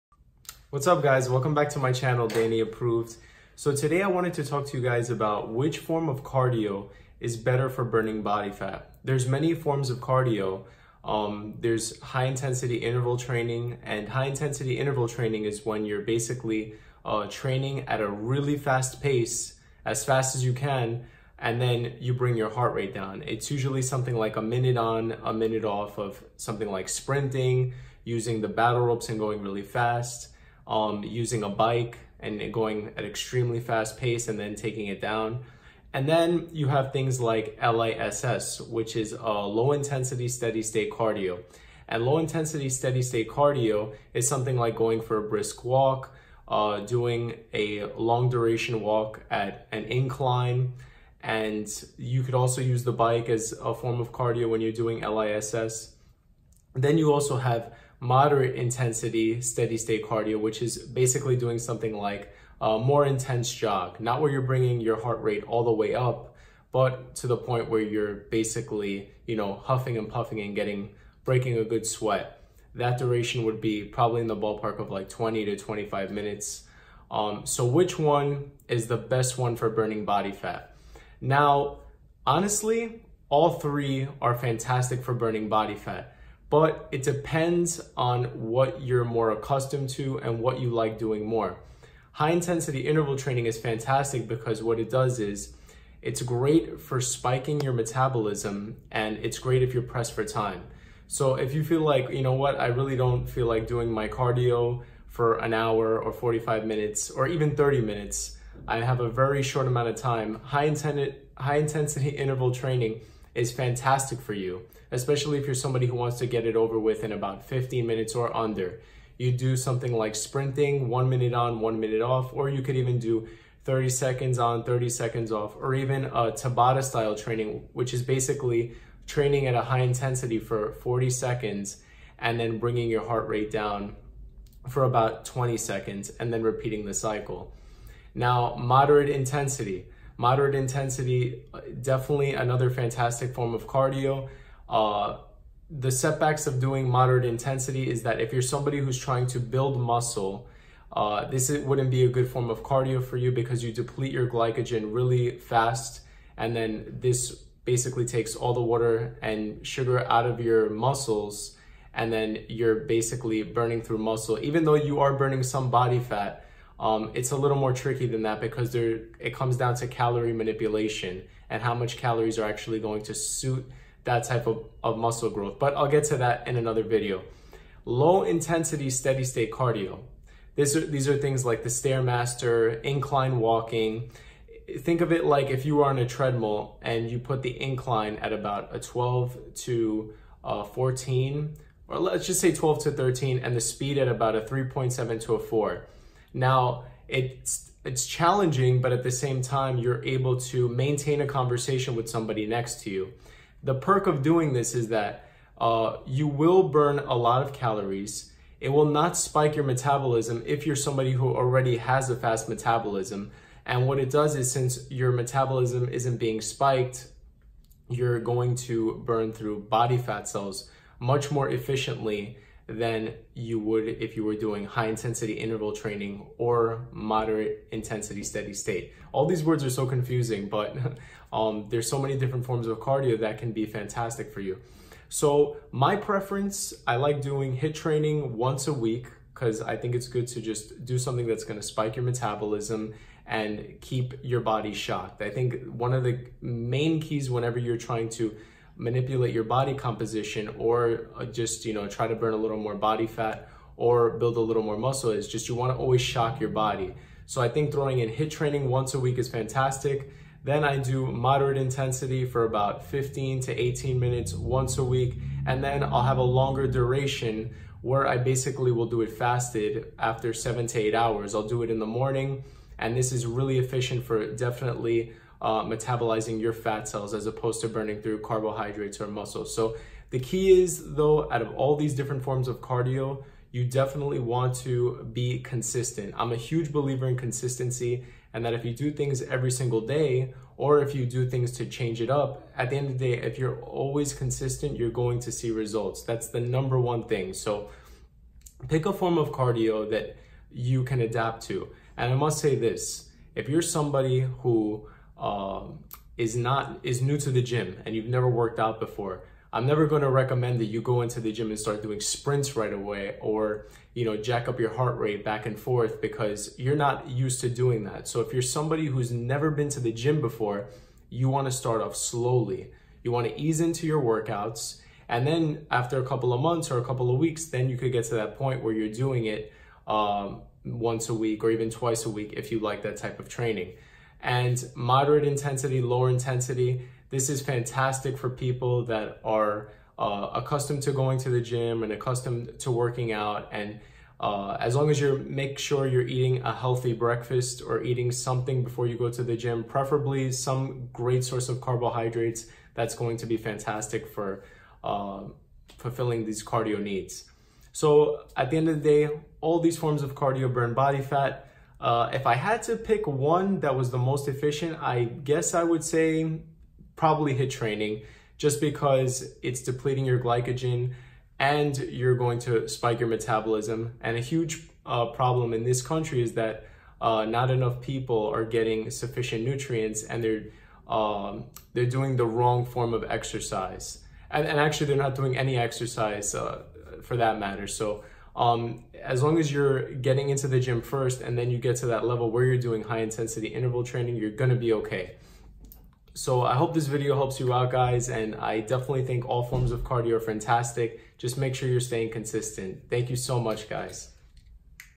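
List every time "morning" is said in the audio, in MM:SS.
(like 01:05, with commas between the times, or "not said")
04:31.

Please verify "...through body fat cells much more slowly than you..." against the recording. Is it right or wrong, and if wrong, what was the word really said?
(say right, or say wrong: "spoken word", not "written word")
wrong: "efficiently", not "slowly".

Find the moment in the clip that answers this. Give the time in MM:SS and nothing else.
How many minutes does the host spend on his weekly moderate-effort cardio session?
04:22.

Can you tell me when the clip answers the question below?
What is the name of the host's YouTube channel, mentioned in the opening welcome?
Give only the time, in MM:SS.
00:02.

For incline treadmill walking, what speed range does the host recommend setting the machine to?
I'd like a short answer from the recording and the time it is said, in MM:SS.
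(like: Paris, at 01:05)
3.7 to 4, at 03:14.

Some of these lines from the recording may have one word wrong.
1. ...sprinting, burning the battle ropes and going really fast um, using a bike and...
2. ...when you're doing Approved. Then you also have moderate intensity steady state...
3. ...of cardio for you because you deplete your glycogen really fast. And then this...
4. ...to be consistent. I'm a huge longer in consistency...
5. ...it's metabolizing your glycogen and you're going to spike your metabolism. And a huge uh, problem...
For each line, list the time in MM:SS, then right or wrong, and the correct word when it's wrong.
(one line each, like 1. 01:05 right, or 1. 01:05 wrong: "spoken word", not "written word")
1. 00:26 wrong: "using", not "burning"
2. 00:54 wrong: "LISS", not "Approved"
3. 02:32 right
4. 04:44 wrong: "believer", not "longer"
5. 06:09 wrong: "depleting", not "metabolizing".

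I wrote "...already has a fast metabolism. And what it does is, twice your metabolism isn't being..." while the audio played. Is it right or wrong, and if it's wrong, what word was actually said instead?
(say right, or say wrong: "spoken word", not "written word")
wrong: "since", not "twice".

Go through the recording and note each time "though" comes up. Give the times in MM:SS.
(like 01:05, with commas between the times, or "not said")
02:44, 04:40.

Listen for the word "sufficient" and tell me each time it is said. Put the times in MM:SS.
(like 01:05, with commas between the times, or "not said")
06:18.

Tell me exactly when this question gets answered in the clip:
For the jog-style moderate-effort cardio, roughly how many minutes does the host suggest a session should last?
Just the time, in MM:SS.
01:15.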